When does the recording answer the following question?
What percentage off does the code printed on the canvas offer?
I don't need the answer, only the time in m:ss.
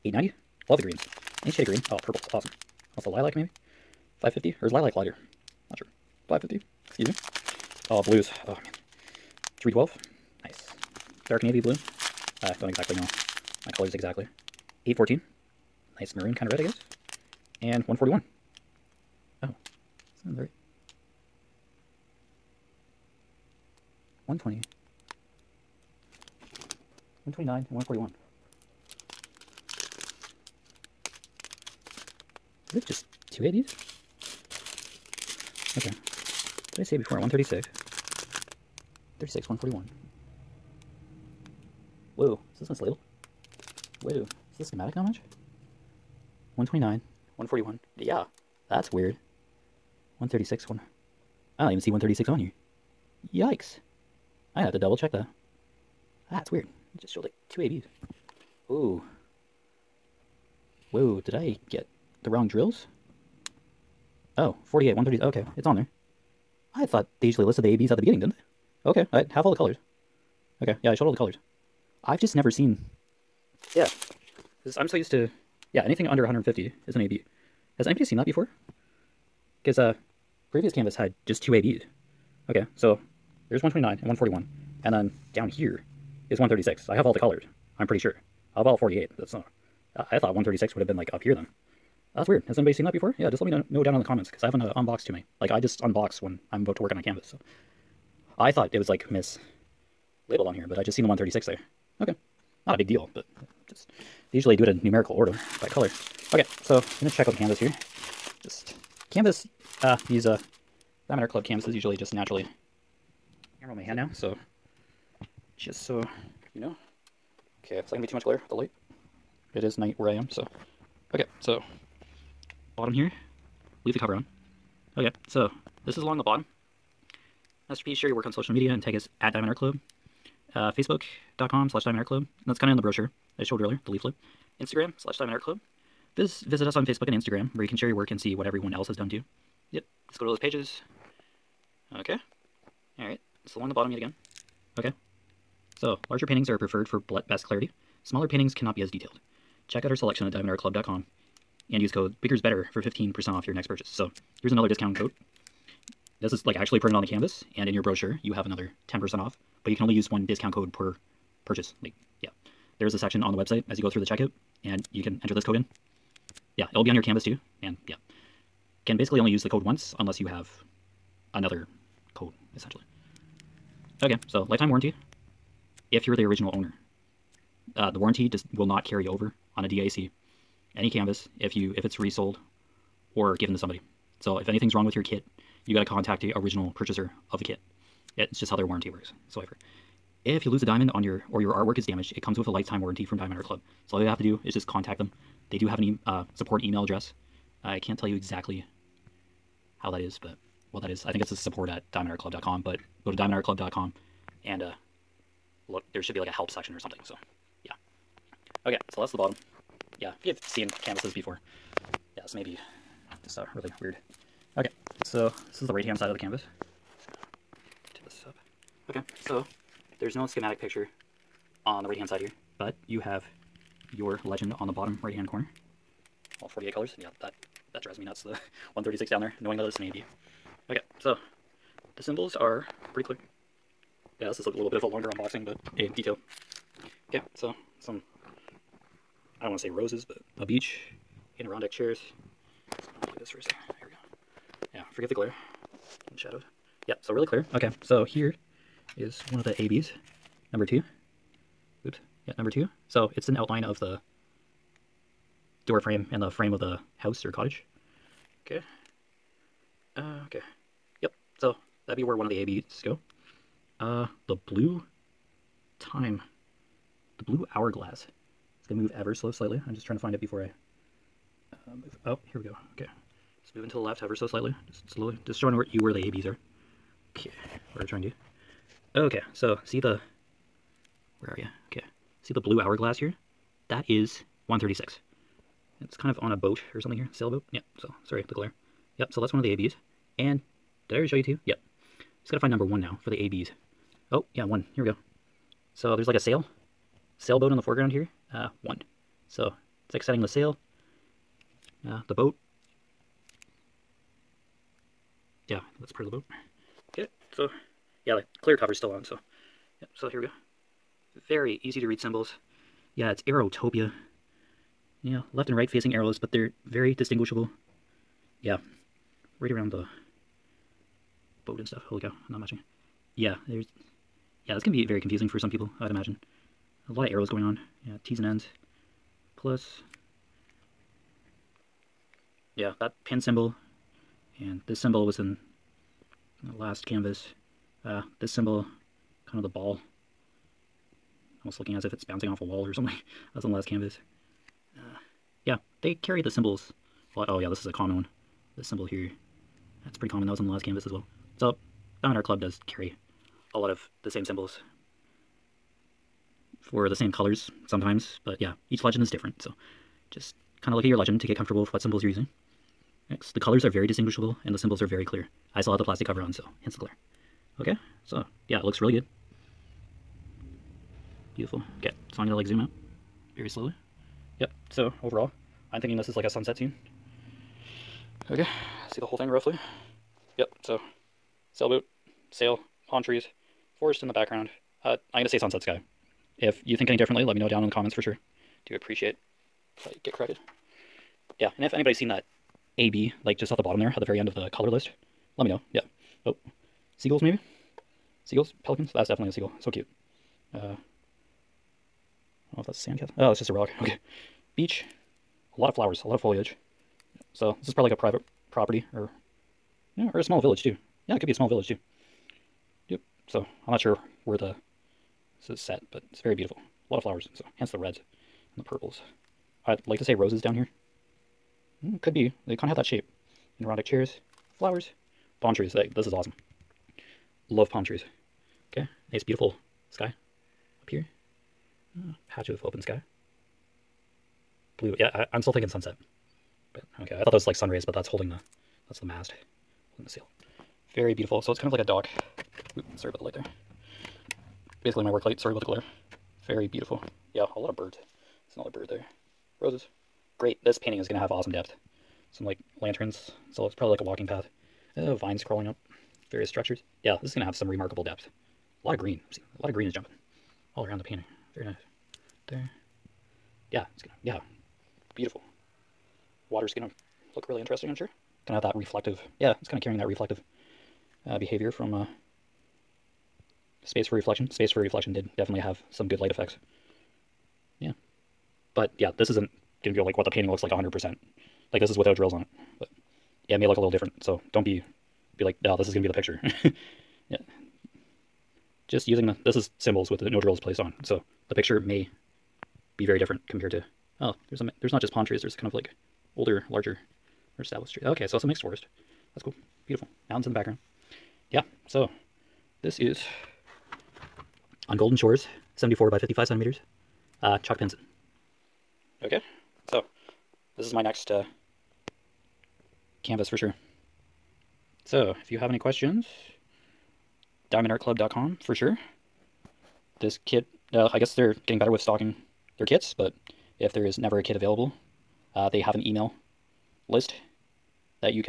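2:32.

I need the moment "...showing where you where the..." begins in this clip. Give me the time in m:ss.
4:35.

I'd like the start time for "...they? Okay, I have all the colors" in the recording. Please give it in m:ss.
1:08.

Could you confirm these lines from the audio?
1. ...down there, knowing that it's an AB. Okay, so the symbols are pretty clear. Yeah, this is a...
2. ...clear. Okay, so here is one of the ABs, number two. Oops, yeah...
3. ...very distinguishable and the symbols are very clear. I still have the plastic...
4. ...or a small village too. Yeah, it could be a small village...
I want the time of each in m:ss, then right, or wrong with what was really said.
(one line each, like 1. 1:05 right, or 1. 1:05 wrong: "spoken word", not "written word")
1. 3:49 right
2. 4:07 right
3. 6:03 right
4. 6:50 right.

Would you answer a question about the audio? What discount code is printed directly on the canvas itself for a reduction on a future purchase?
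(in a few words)
BIGGERSBETTER.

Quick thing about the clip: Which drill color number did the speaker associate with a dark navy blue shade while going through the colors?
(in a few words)
312.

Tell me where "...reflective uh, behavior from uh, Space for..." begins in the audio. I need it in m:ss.
7:50.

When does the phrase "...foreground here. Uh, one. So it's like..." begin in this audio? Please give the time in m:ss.
4:57.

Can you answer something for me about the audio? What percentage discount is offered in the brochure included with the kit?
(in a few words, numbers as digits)
10%.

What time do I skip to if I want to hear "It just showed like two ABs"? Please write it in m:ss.
0:56.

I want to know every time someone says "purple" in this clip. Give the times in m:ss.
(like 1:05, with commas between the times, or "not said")
0:02, 6:58.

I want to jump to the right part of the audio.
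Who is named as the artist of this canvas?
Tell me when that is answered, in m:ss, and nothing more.
8:27.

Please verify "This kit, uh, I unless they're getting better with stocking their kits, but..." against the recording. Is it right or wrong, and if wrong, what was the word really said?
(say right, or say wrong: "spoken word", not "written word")
wrong: "guess", not "unless".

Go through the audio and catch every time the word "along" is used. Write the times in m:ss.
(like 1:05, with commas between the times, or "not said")
2:06, 2:23.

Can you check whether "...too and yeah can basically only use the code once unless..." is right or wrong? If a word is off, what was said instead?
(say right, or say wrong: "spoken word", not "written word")
right.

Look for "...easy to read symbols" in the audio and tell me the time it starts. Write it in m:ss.
5:11.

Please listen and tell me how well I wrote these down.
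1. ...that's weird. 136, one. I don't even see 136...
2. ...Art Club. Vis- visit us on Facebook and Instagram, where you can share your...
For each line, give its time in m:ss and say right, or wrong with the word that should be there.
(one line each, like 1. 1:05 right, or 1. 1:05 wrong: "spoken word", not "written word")
1. 0:48 right
2. 2:15 right.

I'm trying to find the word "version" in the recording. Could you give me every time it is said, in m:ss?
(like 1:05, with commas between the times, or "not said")
not said.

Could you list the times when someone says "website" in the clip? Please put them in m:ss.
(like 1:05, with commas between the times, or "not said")
2:43.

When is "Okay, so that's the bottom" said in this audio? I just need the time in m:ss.
3:28.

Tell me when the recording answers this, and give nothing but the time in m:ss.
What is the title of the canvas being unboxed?
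8:24.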